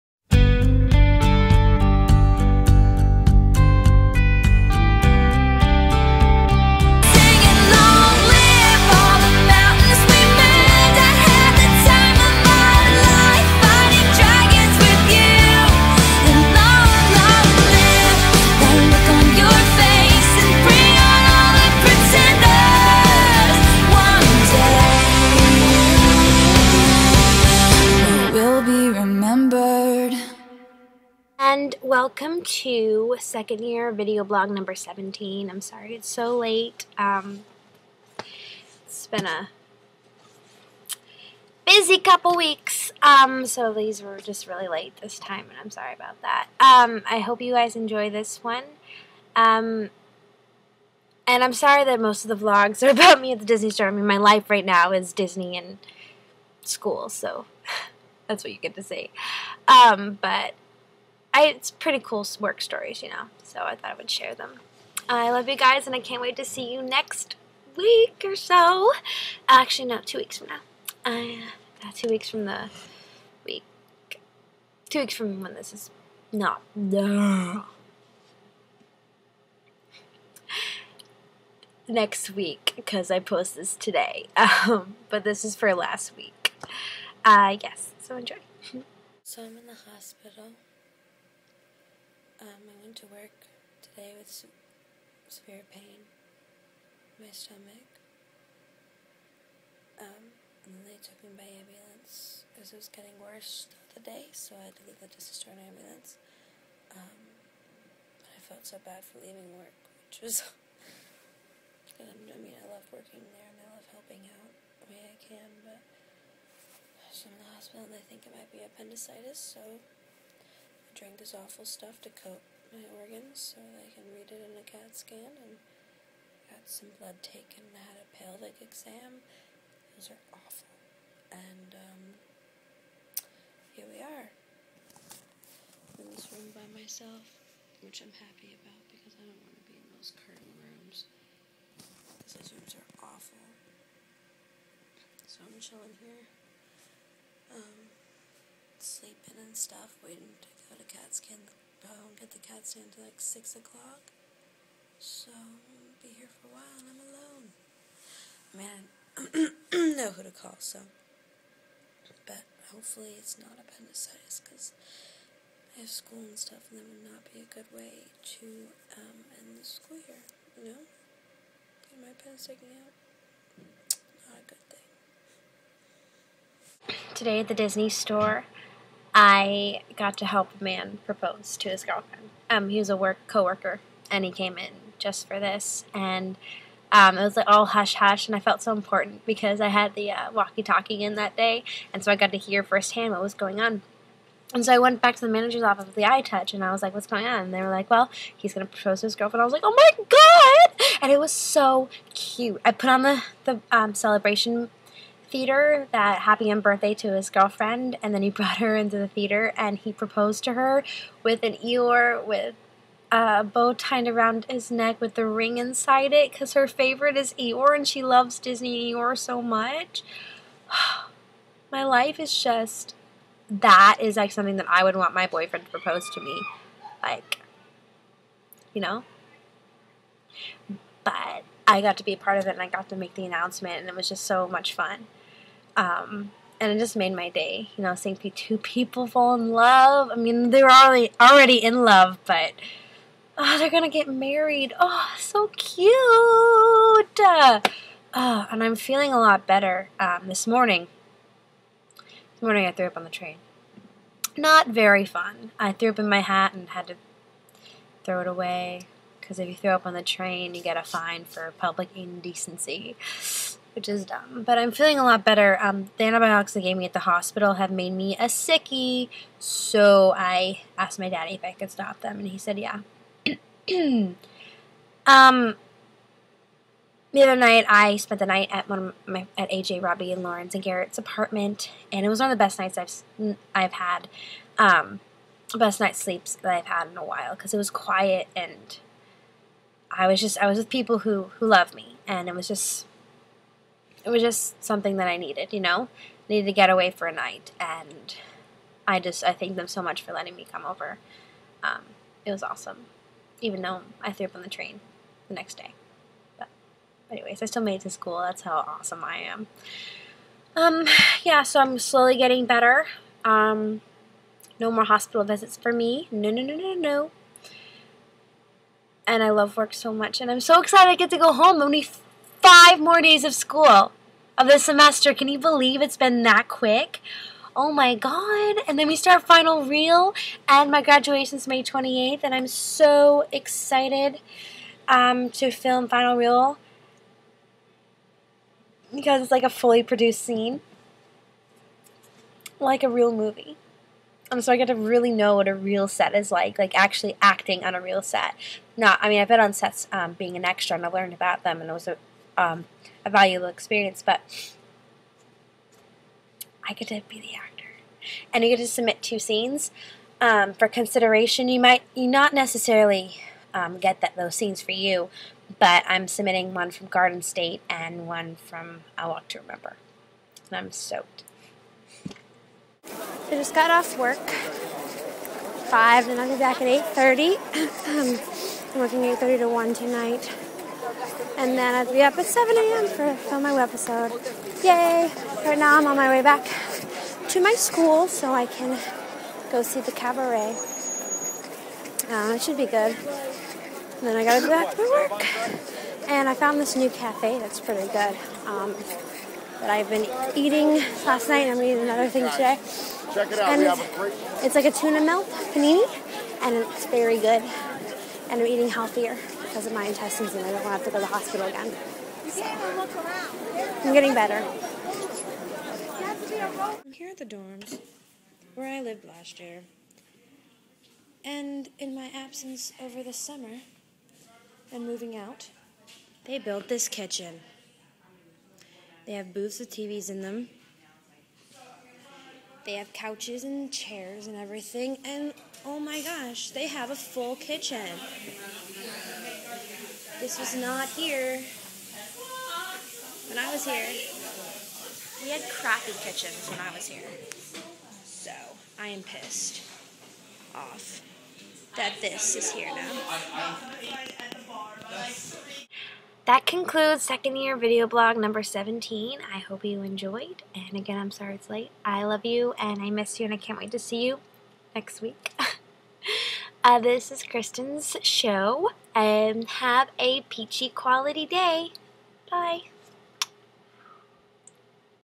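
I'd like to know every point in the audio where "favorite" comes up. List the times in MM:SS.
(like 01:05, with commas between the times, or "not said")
03:36.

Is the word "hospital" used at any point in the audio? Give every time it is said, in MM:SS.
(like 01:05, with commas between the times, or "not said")
01:29, 01:57, 04:26, 05:14, 06:51.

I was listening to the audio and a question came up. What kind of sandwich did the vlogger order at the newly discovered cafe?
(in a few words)
tuna melt panini.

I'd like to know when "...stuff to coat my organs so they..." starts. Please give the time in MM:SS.
02:01.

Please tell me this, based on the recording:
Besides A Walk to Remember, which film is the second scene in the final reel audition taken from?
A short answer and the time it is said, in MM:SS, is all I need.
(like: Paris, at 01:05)
Garden State, at 06:06.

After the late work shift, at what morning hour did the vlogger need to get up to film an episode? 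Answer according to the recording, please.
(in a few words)
7 a.m.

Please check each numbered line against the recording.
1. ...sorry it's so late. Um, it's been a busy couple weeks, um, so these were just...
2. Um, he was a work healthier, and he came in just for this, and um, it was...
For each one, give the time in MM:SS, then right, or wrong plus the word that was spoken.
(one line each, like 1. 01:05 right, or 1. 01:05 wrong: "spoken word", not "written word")
1. 00:35 right
2. 03:02 wrong: "coworker", not "healthier".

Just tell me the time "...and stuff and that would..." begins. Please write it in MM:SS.
02:46.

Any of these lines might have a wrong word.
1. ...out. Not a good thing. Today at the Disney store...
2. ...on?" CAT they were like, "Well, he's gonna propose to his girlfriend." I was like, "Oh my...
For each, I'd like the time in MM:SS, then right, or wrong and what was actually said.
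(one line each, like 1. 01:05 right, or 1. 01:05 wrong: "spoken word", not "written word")
1. 02:52 right
2. 03:17 wrong: "And", not "CAT".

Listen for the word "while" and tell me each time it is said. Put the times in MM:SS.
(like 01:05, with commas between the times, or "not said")
02:36, 04:47.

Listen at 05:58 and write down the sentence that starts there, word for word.
And you get to submit two scenes um, for consideration.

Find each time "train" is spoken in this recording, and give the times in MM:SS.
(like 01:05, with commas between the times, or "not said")
04:13, 04:20, 05:04.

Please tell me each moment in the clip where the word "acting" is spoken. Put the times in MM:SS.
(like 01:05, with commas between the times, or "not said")
05:47.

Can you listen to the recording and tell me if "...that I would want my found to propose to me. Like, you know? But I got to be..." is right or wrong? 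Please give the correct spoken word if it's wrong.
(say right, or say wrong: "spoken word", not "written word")
wrong: "boyfriend", not "found".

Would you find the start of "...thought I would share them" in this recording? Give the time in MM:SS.
01:03.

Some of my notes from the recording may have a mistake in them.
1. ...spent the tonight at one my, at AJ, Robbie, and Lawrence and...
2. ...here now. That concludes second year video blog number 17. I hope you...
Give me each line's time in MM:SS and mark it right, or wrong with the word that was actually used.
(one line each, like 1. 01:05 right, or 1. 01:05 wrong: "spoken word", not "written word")
1. 04:37 wrong: "night", not "tonight"
2. 07:32 right.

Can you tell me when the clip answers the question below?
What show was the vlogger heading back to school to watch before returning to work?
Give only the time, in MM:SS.
06:29.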